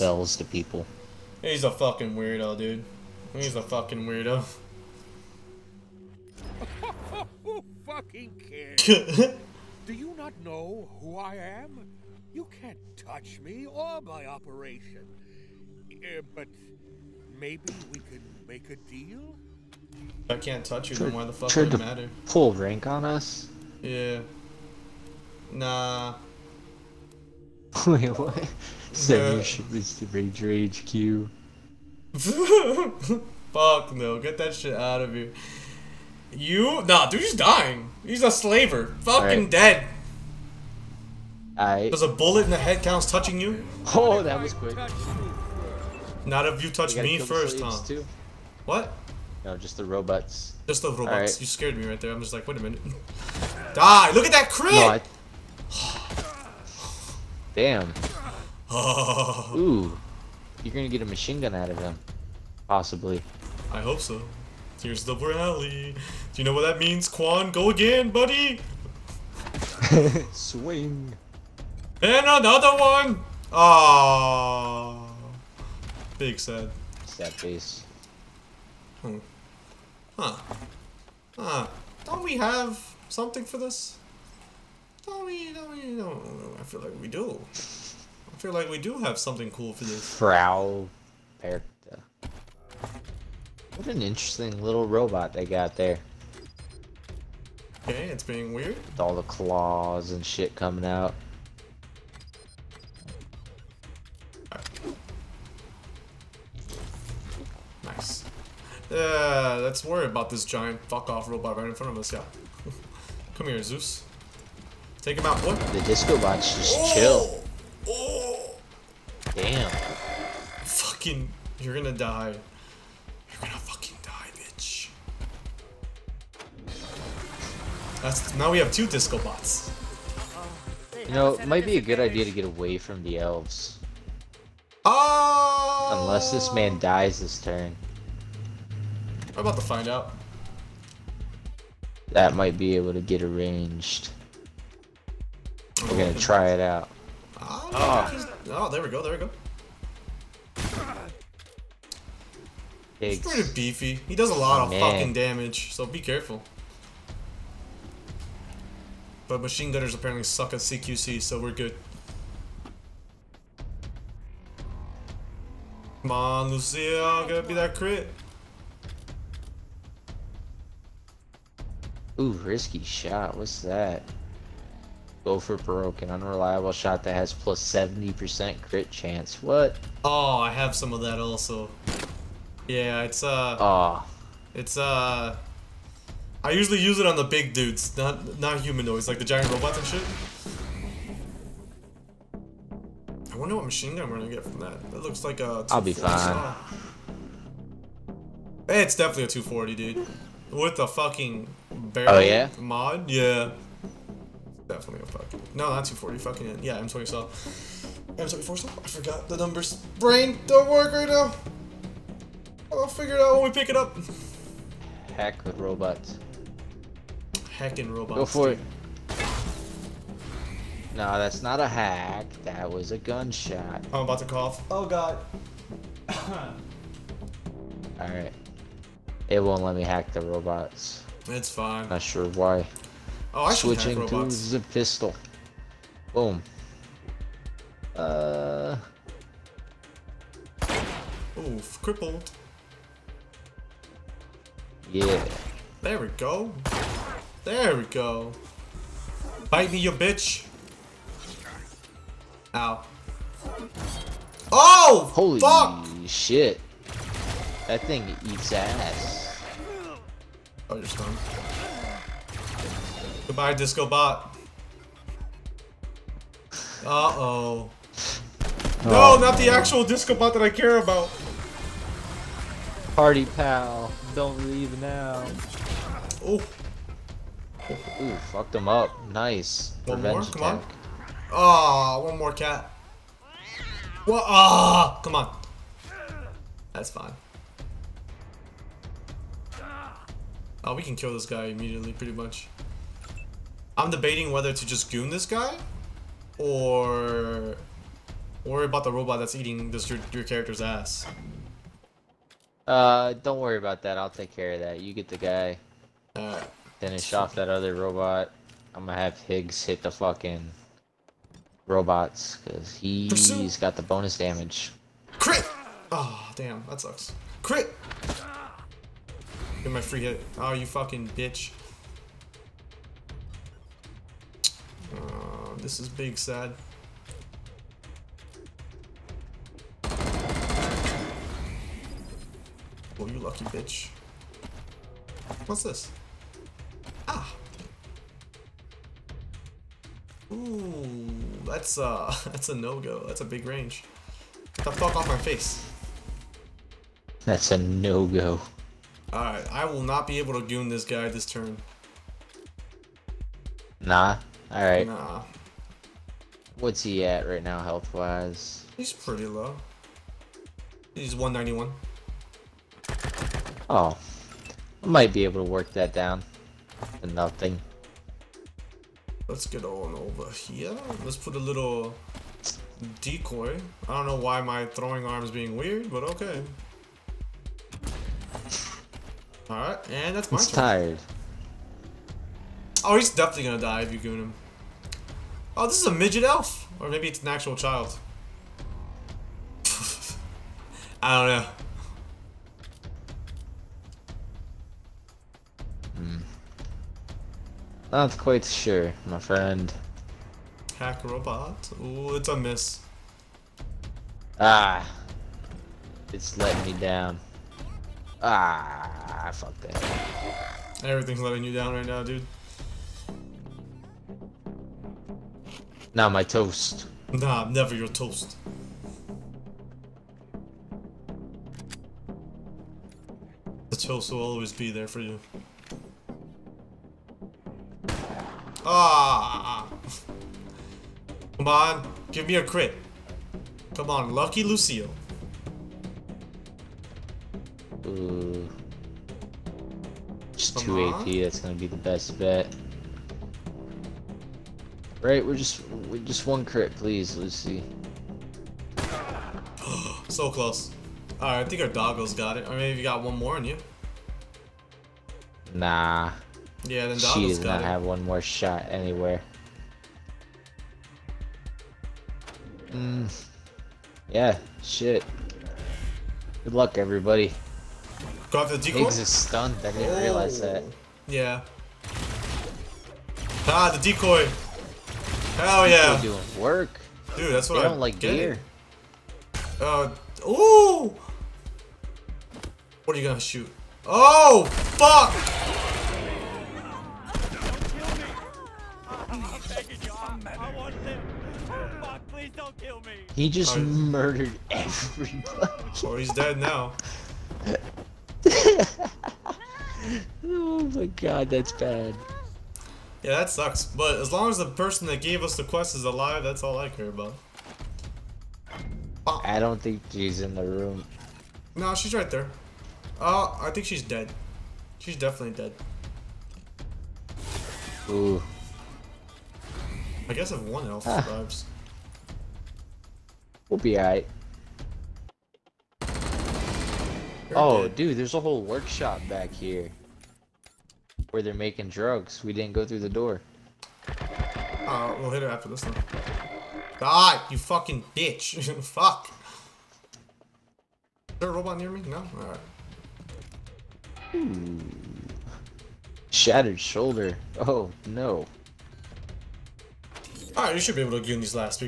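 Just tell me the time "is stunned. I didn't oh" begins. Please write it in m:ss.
7:48.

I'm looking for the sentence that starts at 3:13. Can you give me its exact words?
I wonder what machine gun we're gonna get from that.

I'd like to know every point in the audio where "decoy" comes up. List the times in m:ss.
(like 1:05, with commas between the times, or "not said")
6:13, 7:48, 7:53.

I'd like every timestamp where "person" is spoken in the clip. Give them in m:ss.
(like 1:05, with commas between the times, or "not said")
8:24.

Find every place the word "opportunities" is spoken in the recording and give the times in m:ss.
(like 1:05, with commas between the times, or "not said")
not said.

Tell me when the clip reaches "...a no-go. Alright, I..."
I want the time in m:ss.
5:47.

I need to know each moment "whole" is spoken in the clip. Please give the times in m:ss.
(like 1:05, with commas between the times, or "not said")
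8:48.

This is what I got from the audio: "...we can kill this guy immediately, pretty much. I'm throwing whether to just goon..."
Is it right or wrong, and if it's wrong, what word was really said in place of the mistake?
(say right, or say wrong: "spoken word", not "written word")
wrong: "debating", not "throwing".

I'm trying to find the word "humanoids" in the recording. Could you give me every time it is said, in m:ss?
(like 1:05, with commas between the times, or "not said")
3:08.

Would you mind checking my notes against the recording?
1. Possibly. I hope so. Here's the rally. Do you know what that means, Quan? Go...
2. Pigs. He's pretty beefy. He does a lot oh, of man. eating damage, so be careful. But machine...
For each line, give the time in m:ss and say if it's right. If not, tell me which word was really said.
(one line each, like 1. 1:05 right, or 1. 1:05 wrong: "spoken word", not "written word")
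1. 1:02 right
2. 2:32 wrong: "fucking", not "eating".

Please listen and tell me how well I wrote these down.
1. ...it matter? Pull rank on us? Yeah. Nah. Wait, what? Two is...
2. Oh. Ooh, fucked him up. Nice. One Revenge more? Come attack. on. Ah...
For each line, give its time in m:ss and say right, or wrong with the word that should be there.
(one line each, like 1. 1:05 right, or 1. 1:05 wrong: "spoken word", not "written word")
1. 0:21 wrong: "Seven", not "Two"
2. 4:36 right.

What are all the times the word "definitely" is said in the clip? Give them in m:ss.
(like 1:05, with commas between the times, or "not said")
3:18, 3:24, 6:23, 8:34.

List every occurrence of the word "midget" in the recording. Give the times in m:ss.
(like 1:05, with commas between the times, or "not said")
6:25.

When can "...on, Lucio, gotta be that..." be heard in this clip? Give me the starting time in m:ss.
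2:46.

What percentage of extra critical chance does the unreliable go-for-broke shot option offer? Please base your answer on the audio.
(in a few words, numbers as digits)
70%.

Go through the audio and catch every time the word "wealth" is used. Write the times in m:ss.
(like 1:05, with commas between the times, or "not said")
not said.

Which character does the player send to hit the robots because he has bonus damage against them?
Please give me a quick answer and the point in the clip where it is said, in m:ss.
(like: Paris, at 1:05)
Higgs, at 5:09.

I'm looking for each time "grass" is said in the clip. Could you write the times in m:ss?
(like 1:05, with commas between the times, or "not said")
not said.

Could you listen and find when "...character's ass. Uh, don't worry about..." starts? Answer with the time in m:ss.
5:00.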